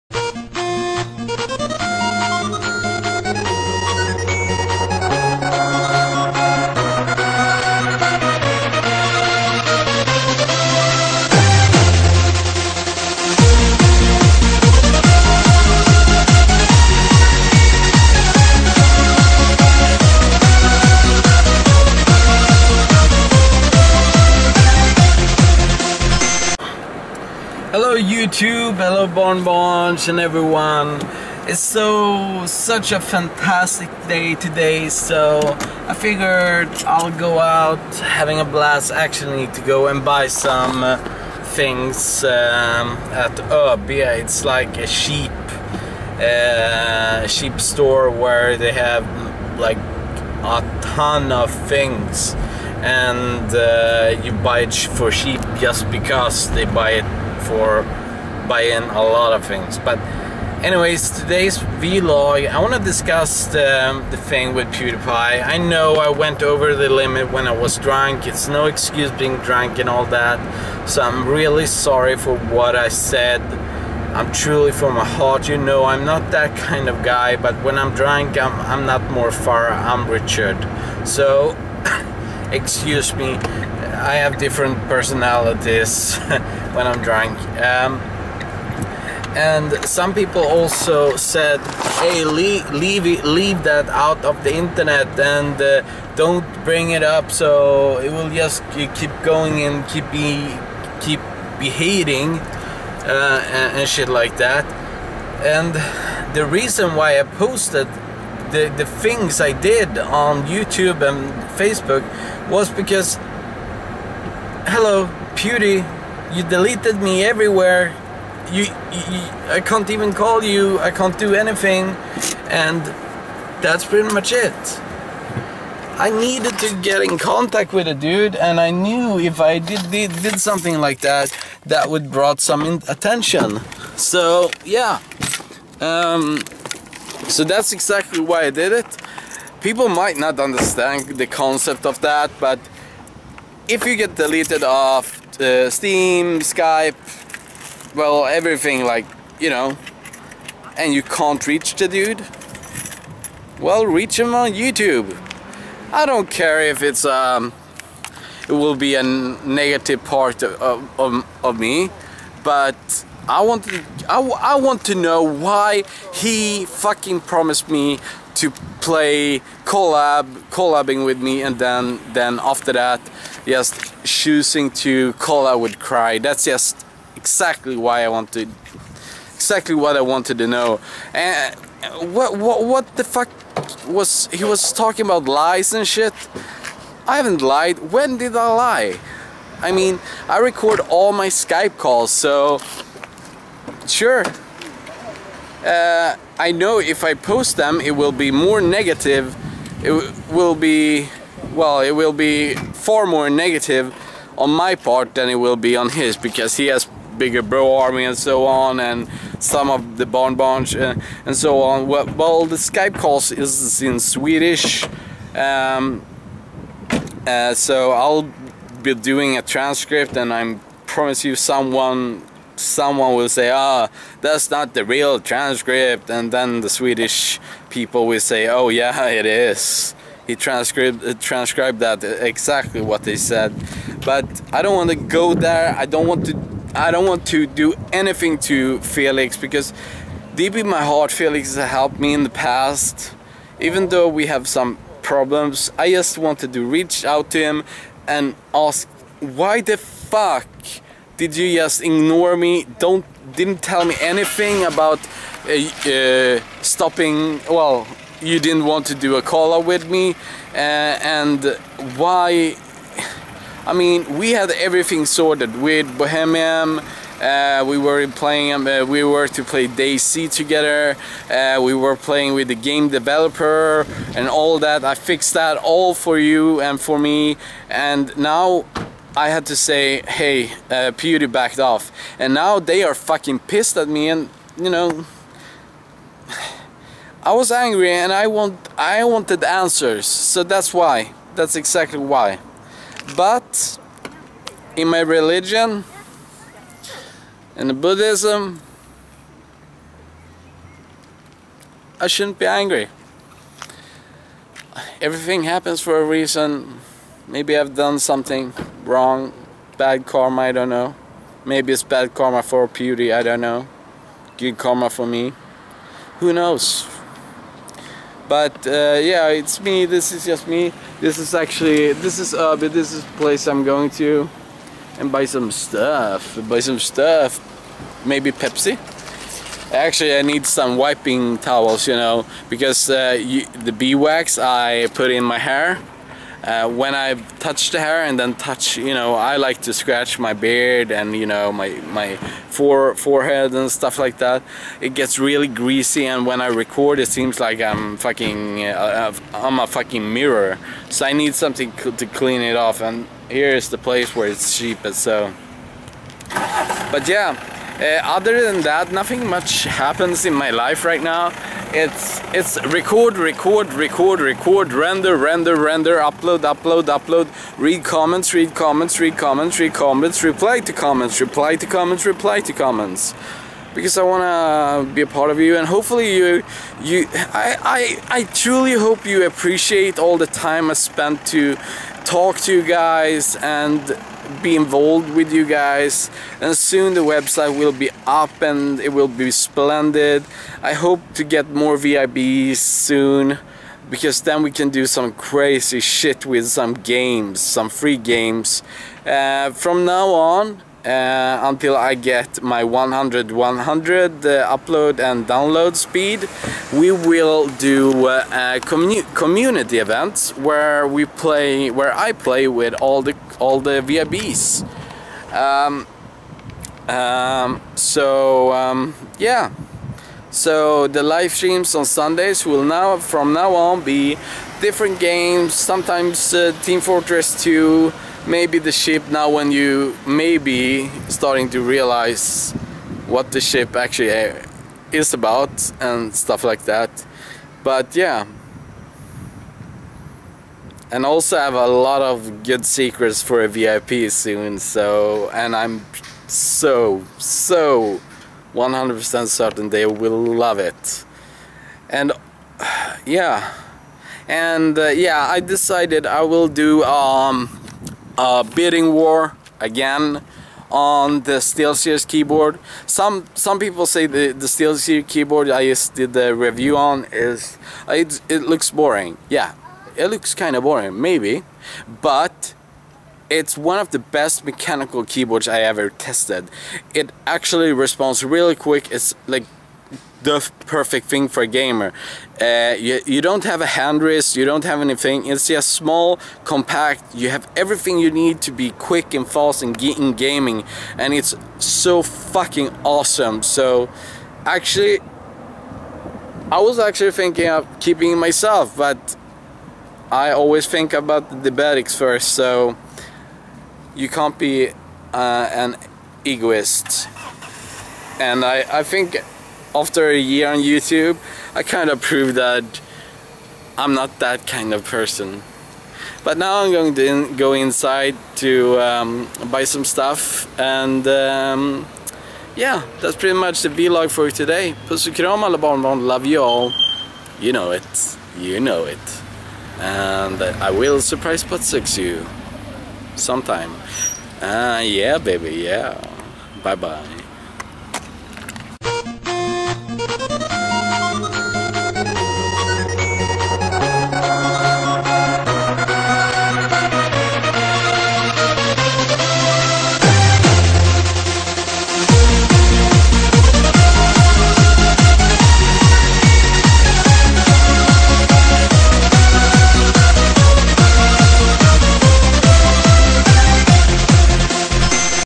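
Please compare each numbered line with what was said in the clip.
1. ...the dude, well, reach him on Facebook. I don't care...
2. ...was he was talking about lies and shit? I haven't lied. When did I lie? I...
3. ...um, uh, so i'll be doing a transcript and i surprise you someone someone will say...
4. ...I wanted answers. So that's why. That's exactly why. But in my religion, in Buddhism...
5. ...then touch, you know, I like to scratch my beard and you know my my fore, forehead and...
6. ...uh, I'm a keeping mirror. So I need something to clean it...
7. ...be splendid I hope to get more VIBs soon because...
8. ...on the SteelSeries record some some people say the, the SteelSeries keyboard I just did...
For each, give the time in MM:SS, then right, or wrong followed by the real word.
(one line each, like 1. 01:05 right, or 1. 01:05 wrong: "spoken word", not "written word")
1. 02:31 wrong: "YouTube", not "Facebook"
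2. 03:03 right
3. 03:35 wrong: "promise", not "surprise"
4. 04:48 right
5. 05:38 right
6. 05:48 wrong: "fucking", not "keeping"
7. 06:29 right
8. 07:40 wrong: "keyboard", not "record".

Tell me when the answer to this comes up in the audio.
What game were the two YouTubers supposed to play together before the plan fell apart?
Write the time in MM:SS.
04:29.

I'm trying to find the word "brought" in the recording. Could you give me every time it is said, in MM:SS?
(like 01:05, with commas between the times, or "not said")
02:12.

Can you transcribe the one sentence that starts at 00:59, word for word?
But anyways, today's vlog, I want to discuss the, the thing with PewDiePie.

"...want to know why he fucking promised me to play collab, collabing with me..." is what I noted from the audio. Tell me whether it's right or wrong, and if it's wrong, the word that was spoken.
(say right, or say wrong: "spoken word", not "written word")
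right.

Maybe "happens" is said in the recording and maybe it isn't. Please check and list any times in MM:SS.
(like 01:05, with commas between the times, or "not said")
05:05, 05:59.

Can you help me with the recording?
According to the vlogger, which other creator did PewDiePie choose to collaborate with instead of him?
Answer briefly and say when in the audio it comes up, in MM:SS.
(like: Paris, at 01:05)
Cry, at 02:55.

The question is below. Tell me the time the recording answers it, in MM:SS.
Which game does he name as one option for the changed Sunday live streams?
07:06.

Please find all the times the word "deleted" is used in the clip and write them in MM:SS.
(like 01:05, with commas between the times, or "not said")
01:56, 02:24.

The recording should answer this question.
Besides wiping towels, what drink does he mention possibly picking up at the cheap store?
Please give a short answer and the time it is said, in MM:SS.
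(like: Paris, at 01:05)
Pepsi, at 05:28.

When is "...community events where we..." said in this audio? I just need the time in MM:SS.
06:49.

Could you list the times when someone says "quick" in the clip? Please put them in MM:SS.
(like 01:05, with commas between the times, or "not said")
07:58, 08:08.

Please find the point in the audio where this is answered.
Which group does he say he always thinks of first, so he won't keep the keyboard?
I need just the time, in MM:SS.
08:21.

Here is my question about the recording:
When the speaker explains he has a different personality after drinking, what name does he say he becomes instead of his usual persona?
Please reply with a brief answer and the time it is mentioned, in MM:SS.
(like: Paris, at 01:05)
Richard, at 01:19.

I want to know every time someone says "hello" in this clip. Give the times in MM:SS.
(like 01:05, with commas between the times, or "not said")
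00:28, 01:54.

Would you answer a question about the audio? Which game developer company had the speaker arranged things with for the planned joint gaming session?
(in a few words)
Bohemian.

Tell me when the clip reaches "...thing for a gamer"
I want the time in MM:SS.
08:01.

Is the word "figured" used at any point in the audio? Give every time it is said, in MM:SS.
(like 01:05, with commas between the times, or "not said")
00:35.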